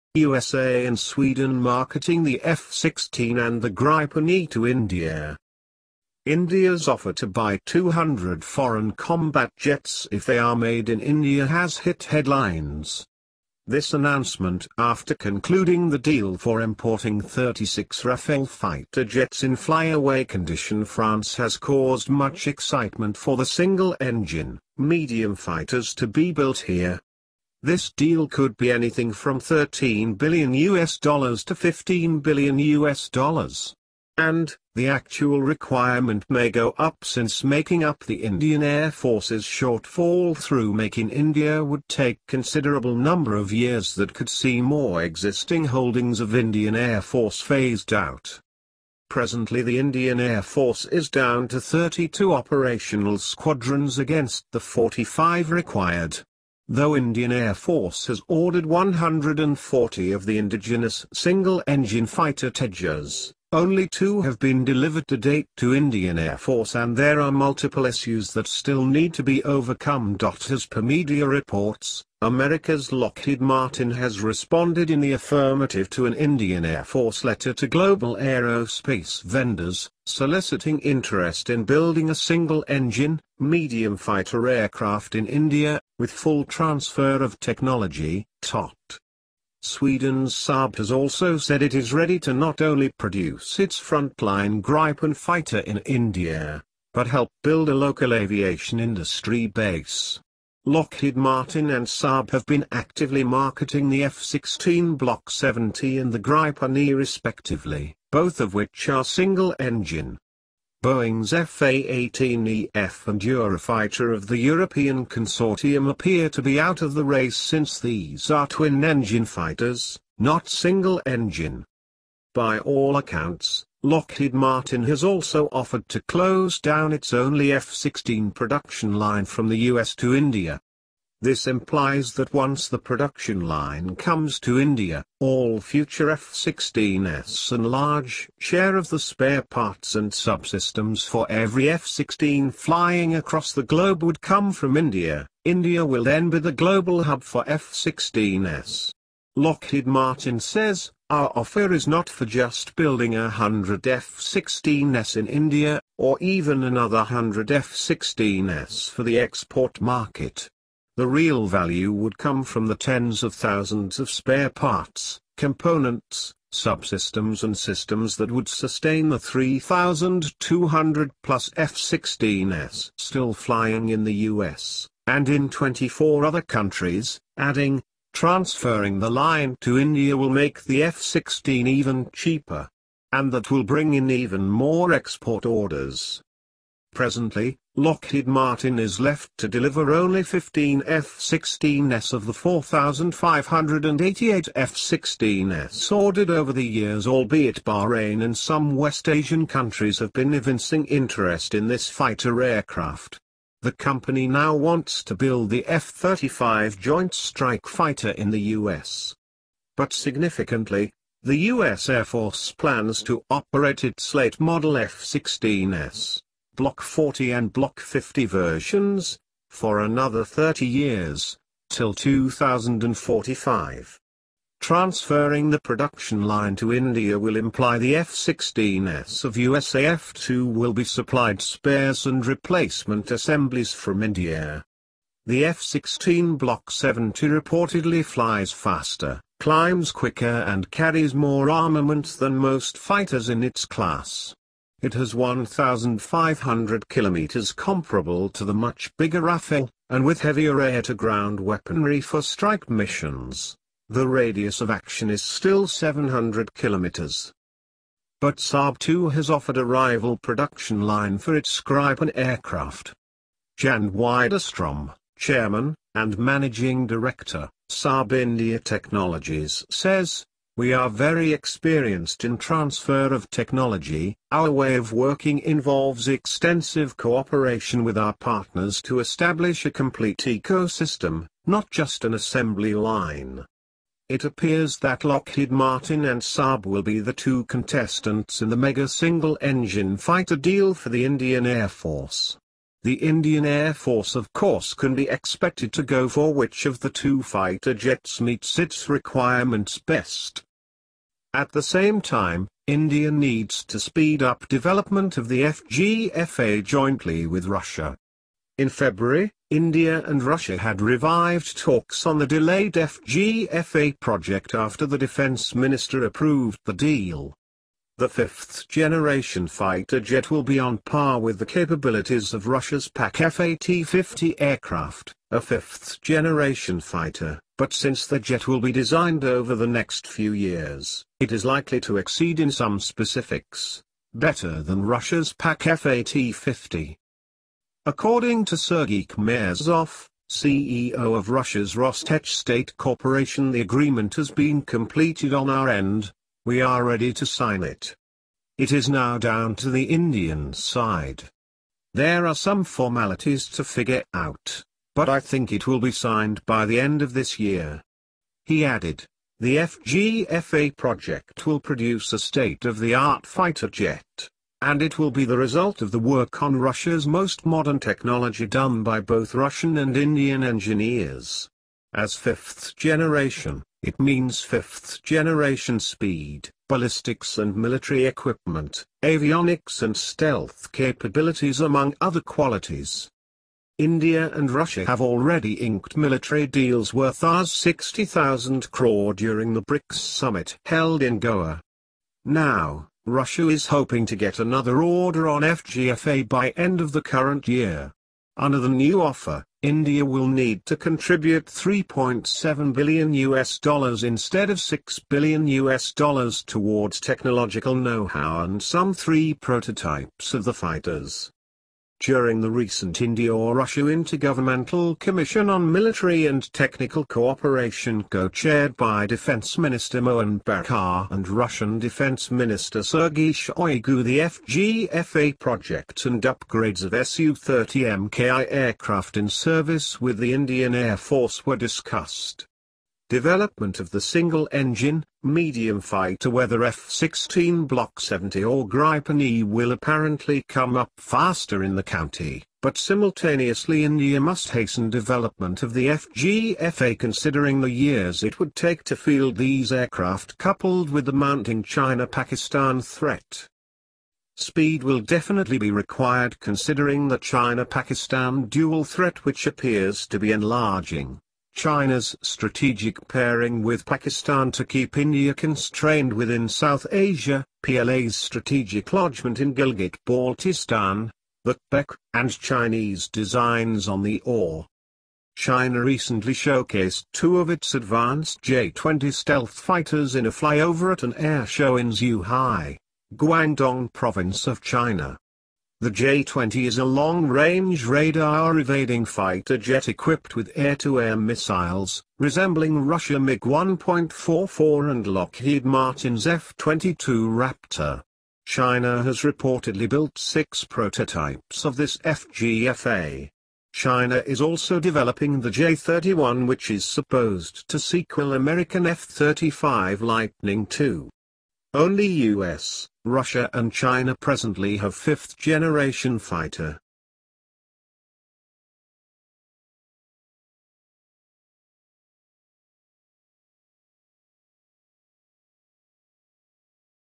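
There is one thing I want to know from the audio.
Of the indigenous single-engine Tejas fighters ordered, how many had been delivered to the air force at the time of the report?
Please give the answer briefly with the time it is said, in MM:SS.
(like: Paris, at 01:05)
2, at 01:03.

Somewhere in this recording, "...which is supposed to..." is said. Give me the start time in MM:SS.
08:26.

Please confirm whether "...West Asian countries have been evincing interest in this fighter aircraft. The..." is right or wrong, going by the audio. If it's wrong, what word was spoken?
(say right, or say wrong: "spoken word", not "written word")
right.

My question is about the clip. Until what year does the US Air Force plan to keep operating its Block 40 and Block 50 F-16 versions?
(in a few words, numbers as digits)
2045.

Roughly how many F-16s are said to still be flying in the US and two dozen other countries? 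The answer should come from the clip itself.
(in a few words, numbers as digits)
3,200 plus.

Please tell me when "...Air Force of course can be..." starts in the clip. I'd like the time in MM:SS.
04:53.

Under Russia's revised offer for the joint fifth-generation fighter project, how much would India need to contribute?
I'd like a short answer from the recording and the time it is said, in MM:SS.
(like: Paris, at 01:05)
3.7 billion US dollars, at 06:41.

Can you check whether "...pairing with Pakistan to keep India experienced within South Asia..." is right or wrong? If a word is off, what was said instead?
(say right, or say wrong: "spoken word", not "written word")
wrong: "constrained", not "experienced".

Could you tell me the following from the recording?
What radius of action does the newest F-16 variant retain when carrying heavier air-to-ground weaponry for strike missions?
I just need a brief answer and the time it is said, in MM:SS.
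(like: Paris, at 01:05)
700 kilometers, at 04:15.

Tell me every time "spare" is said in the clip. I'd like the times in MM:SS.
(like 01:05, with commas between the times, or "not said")
02:18, 02:44, 03:51.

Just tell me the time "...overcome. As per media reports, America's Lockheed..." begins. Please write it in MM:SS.
01:09.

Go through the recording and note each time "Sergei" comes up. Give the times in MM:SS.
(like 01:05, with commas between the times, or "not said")
05:38, 07:02.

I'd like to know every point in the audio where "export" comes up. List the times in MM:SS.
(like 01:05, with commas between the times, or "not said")
02:39, 03:04.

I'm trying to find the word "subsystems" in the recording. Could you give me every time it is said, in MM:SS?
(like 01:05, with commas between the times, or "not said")
02:20, 02:46.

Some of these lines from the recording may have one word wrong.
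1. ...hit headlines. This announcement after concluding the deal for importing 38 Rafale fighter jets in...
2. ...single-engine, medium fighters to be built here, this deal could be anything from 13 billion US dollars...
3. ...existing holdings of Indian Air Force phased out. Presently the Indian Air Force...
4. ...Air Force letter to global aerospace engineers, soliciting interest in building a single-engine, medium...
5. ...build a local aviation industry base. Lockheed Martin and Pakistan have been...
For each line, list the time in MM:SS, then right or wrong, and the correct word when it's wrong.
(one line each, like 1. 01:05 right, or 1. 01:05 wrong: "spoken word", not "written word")
1. 00:11 wrong: "36", not "38"
2. 00:23 right
3. 00:45 right
4. 01:16 wrong: "vendors", not "engineers"
5. 01:37 wrong: "Saab", not "Pakistan".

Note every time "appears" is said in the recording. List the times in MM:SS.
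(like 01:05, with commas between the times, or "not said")
01:55, 04:44, 07:39.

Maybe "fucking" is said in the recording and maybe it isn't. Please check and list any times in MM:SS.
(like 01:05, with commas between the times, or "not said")
not said.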